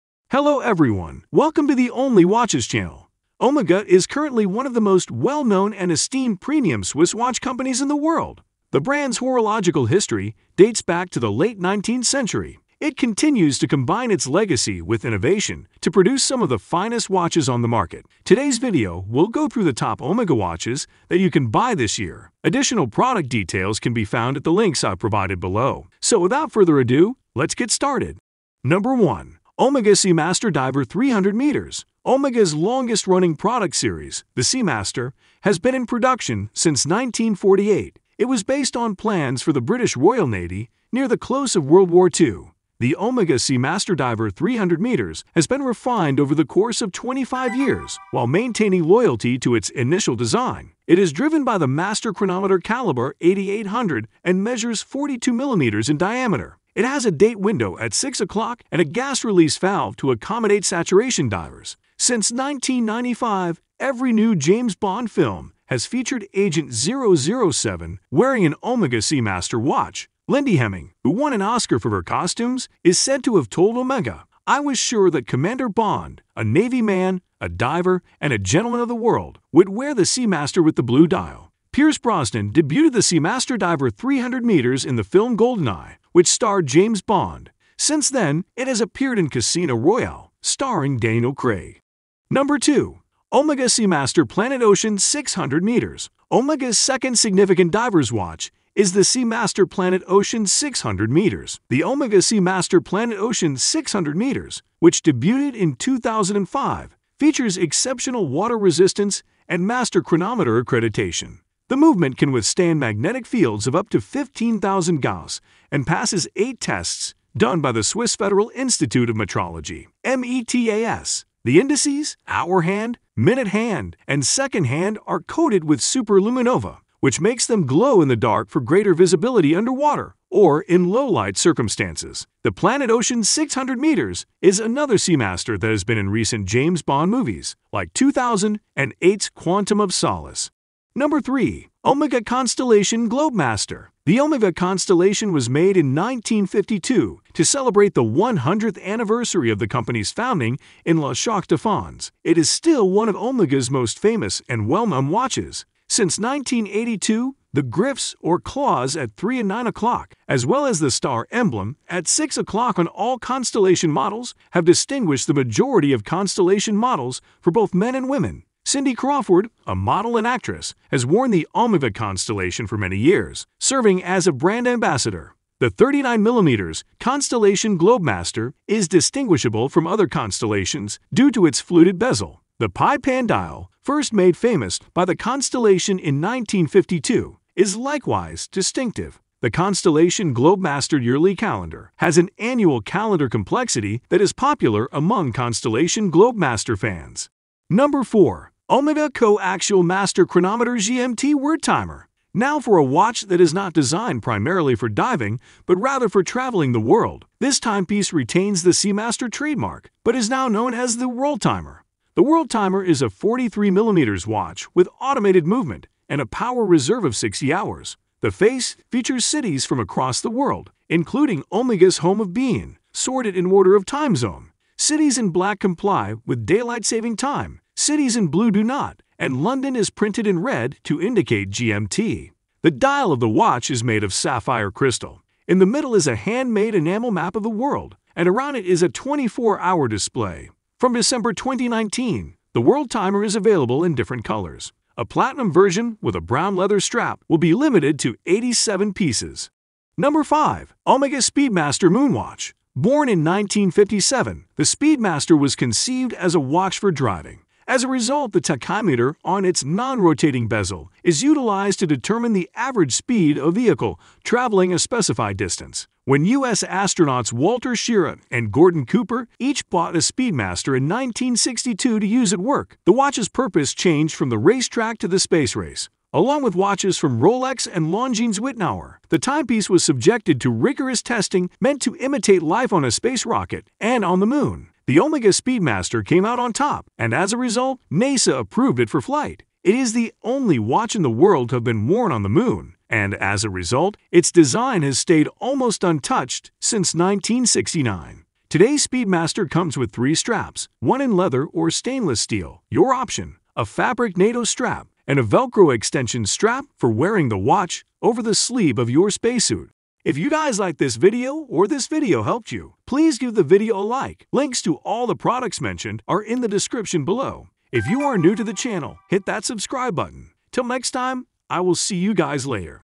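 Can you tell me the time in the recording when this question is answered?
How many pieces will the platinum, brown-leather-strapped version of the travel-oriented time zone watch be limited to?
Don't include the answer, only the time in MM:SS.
04:08.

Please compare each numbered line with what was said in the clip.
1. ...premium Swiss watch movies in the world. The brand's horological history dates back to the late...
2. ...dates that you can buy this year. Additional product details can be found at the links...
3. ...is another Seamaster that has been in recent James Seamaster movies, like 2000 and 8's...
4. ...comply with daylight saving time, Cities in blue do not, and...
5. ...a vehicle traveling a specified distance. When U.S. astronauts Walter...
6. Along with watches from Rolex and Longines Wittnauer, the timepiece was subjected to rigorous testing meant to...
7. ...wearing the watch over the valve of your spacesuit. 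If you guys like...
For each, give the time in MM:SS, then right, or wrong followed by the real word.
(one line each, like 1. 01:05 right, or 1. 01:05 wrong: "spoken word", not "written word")
1. 00:06 wrong: "companies", not "movies"
2. 00:20 wrong: "watches", not "dates"
3. 02:14 wrong: "Bond", not "Seamaster"
4. 03:45 right
5. 04:23 right
6. 04:36 right
7. 05:06 wrong: "sleeve", not "valve".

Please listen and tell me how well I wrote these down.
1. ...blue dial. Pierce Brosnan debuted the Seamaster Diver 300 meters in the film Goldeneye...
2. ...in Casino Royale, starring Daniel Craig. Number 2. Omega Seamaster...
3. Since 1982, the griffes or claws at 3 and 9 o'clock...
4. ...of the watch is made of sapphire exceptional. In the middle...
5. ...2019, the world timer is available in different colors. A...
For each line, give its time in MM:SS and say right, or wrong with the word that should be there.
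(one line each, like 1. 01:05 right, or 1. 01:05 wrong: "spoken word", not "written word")
1. 01:20 right
2. 01:29 right
3. 02:35 right
4. 03:53 wrong: "crystal", not "exceptional"
5. 04:01 right.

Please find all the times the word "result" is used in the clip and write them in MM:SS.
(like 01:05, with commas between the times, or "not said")
04:17, 04:47, 04:53.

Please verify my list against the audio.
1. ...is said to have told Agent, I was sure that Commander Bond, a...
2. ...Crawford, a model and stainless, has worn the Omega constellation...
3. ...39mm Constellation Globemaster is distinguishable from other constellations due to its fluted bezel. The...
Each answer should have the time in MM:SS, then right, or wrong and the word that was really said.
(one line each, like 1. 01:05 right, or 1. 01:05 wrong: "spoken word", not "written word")
1. 01:12 wrong: "Omega", not "Agent"
2. 02:48 wrong: "actress", not "stainless"
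3. 02:55 right.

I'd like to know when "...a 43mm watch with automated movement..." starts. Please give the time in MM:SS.
03:33.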